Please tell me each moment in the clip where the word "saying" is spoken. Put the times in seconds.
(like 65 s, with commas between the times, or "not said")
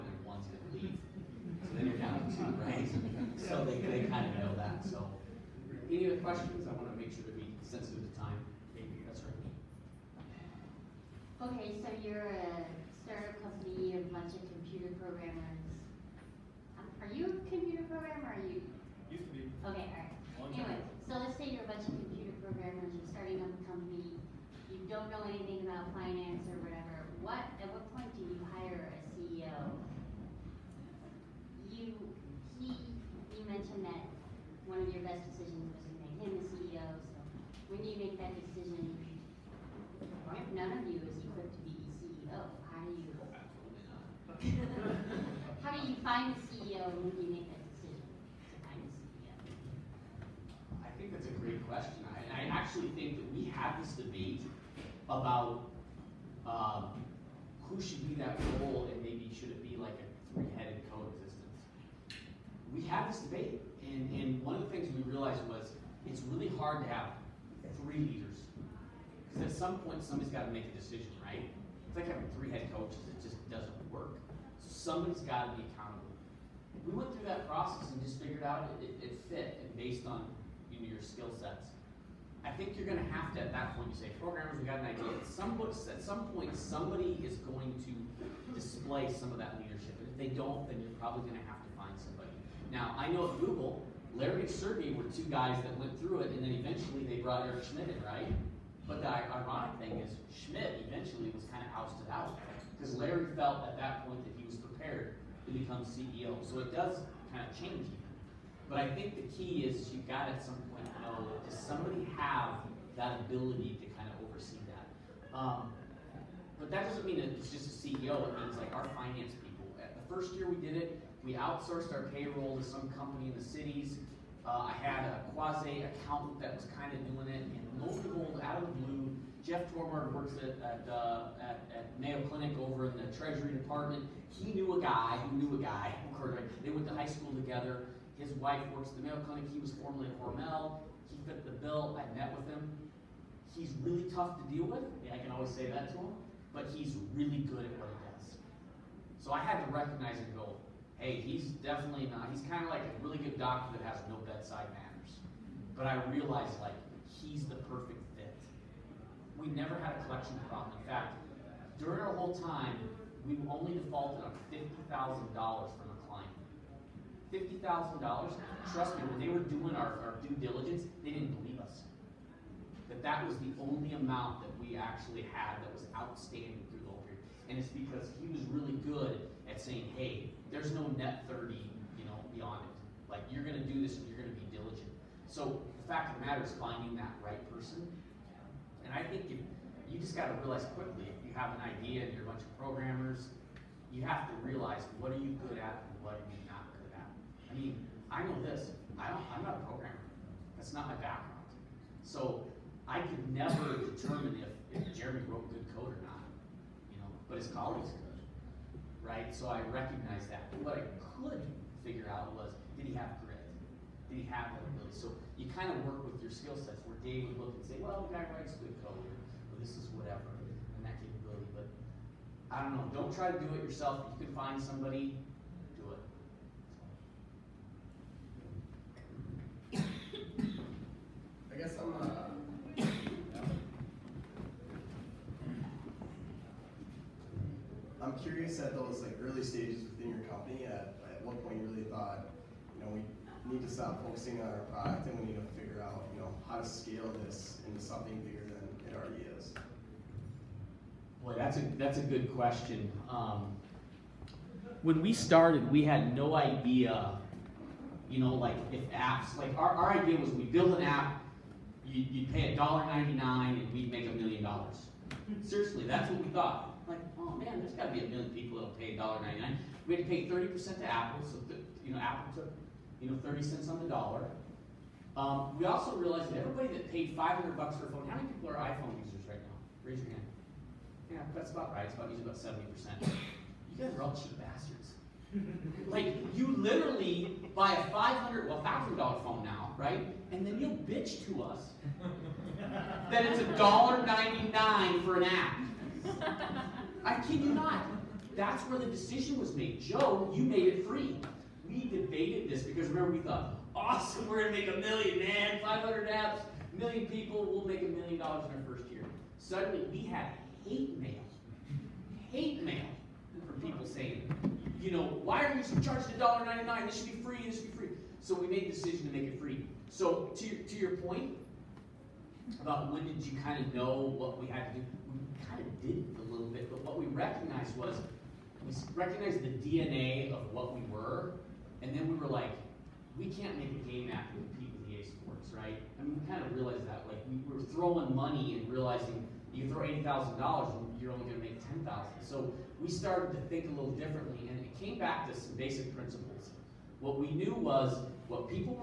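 179 s, 313 s.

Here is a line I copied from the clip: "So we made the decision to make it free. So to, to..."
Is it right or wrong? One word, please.
right.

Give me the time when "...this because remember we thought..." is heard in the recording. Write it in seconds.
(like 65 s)
302 s.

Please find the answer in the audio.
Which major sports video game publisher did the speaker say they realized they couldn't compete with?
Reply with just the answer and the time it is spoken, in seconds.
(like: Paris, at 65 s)
EA Sports, at 334 s.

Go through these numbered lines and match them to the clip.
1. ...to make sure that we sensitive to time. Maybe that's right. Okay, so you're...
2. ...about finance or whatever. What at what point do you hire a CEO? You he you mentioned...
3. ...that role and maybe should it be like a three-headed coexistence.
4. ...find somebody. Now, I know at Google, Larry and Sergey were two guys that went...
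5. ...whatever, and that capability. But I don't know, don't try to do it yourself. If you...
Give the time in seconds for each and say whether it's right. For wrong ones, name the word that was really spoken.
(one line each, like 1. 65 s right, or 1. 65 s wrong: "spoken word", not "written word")
1. 6 s right
2. 25 s right
3. 58 s right
4. 91 s right
5. 219 s right.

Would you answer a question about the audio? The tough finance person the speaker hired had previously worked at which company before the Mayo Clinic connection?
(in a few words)
Hormel.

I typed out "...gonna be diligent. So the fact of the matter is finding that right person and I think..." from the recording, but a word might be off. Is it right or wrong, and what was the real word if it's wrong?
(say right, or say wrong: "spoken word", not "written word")
right.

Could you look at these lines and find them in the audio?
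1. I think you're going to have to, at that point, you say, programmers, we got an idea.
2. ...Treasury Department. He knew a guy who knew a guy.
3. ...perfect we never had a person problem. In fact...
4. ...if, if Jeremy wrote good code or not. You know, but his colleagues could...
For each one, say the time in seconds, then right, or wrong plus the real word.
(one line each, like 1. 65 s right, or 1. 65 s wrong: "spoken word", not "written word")
1. 82 s right
2. 133 s right
3. 157 s wrong: "collection", not "person"
4. 204 s right.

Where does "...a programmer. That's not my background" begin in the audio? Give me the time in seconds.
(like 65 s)
199 s.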